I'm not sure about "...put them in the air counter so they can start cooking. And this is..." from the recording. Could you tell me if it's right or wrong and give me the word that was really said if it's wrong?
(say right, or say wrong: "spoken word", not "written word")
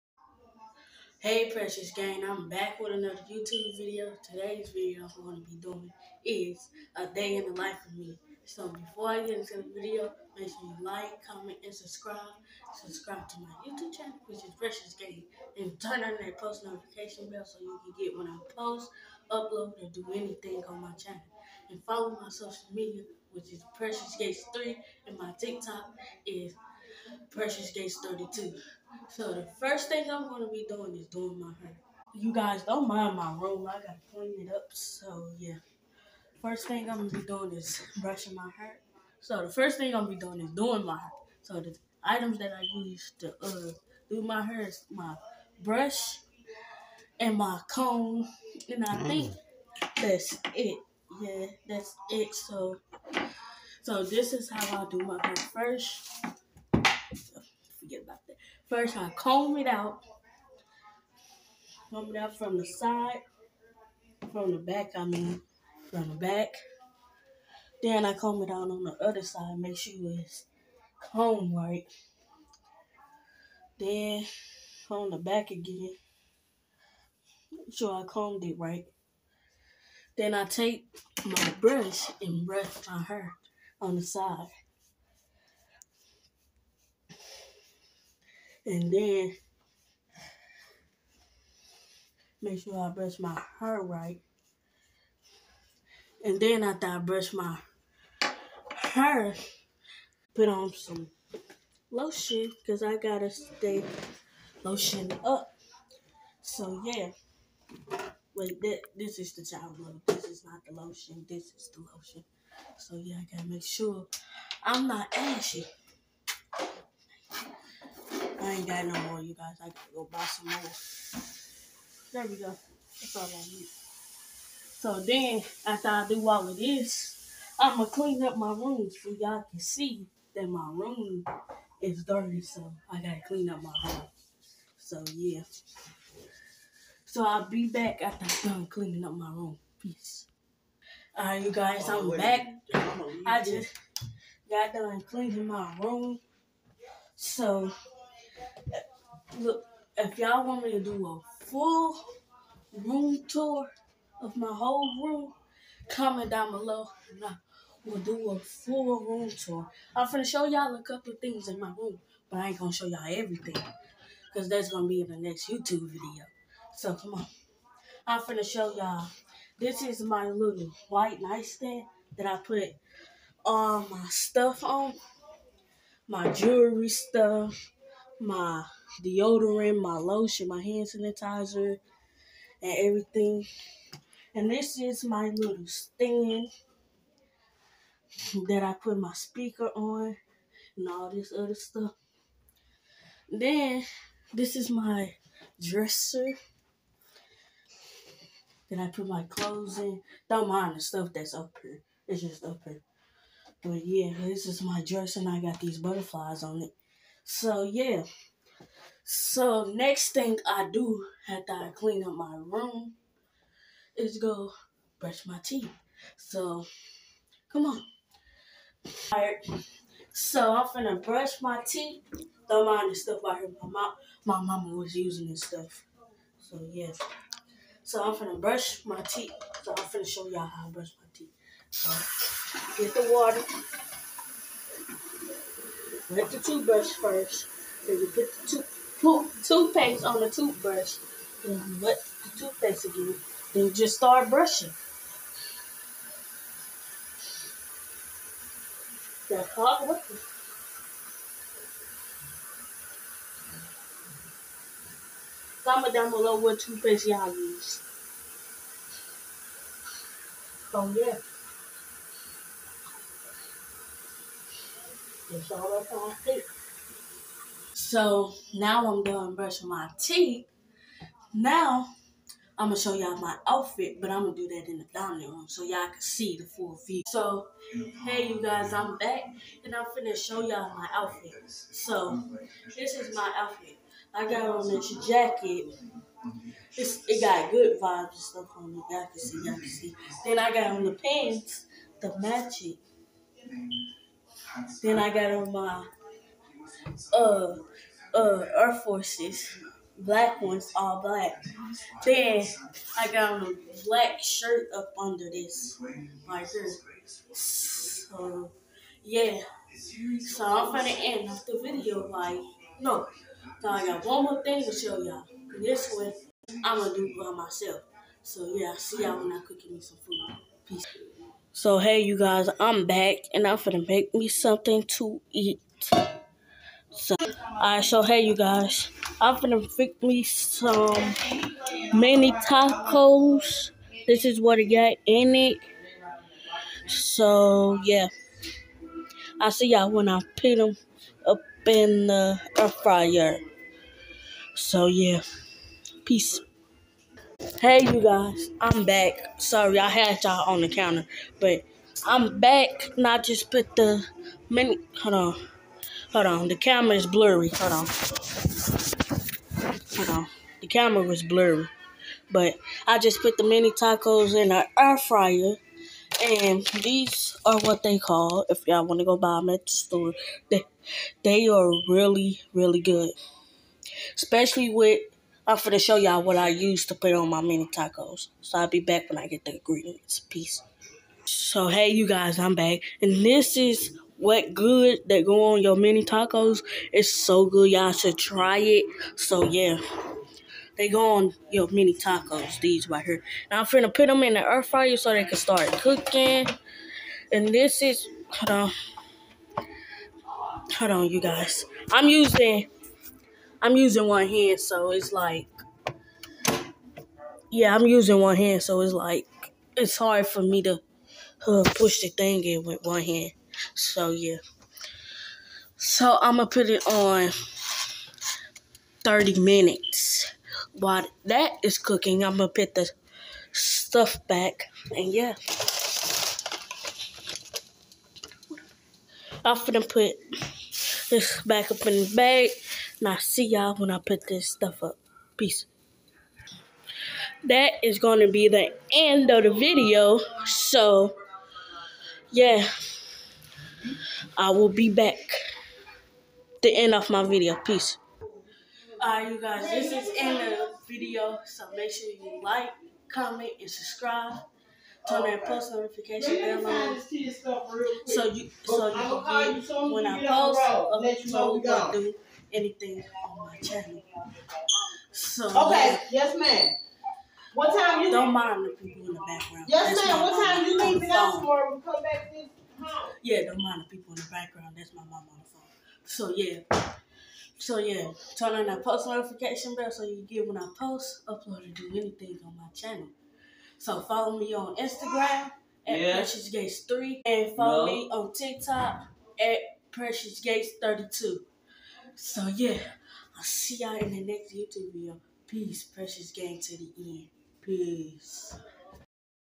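wrong: "fryer", not "counter".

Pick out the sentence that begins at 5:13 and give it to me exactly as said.
So I got one more thing to show y'all.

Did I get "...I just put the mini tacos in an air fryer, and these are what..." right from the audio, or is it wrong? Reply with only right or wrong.
right.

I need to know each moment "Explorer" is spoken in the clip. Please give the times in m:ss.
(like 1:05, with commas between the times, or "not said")
not said.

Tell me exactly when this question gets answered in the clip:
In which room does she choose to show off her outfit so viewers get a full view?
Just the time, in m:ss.
4:34.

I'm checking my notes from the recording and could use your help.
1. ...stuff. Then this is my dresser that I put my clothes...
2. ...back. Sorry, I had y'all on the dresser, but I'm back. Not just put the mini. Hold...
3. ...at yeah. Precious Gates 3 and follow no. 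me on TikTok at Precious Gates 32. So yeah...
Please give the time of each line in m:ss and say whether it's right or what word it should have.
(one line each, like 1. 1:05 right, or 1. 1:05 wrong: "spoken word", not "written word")
1. 3:11 right
2. 5:48 wrong: "counter", not "dresser"
3. 8:05 right.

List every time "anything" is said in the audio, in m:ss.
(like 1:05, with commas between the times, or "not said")
0:20, 7:42, 8:01.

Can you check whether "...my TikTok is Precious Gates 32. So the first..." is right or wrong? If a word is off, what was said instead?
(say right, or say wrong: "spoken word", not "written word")
right.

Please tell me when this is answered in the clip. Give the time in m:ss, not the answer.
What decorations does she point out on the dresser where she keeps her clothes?
3:25.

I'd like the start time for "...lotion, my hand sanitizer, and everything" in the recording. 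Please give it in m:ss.
2:59.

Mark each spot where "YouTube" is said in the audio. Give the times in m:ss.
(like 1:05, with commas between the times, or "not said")
0:03, 0:13, 2:45, 8:14.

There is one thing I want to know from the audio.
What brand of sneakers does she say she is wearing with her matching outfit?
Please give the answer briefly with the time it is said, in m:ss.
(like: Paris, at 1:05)
Air Forces, at 4:58.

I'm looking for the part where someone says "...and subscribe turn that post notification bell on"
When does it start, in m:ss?
7:33.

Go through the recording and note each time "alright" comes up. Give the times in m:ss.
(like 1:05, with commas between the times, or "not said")
3:39, 5:27, 7:29.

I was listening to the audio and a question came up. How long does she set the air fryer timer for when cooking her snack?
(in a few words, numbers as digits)
30 minutes.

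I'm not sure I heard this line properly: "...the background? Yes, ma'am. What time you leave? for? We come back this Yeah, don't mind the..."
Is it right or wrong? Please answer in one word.
right.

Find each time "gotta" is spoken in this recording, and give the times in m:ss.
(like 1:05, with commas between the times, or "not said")
1:42, 1:53, 1:59, 2:12.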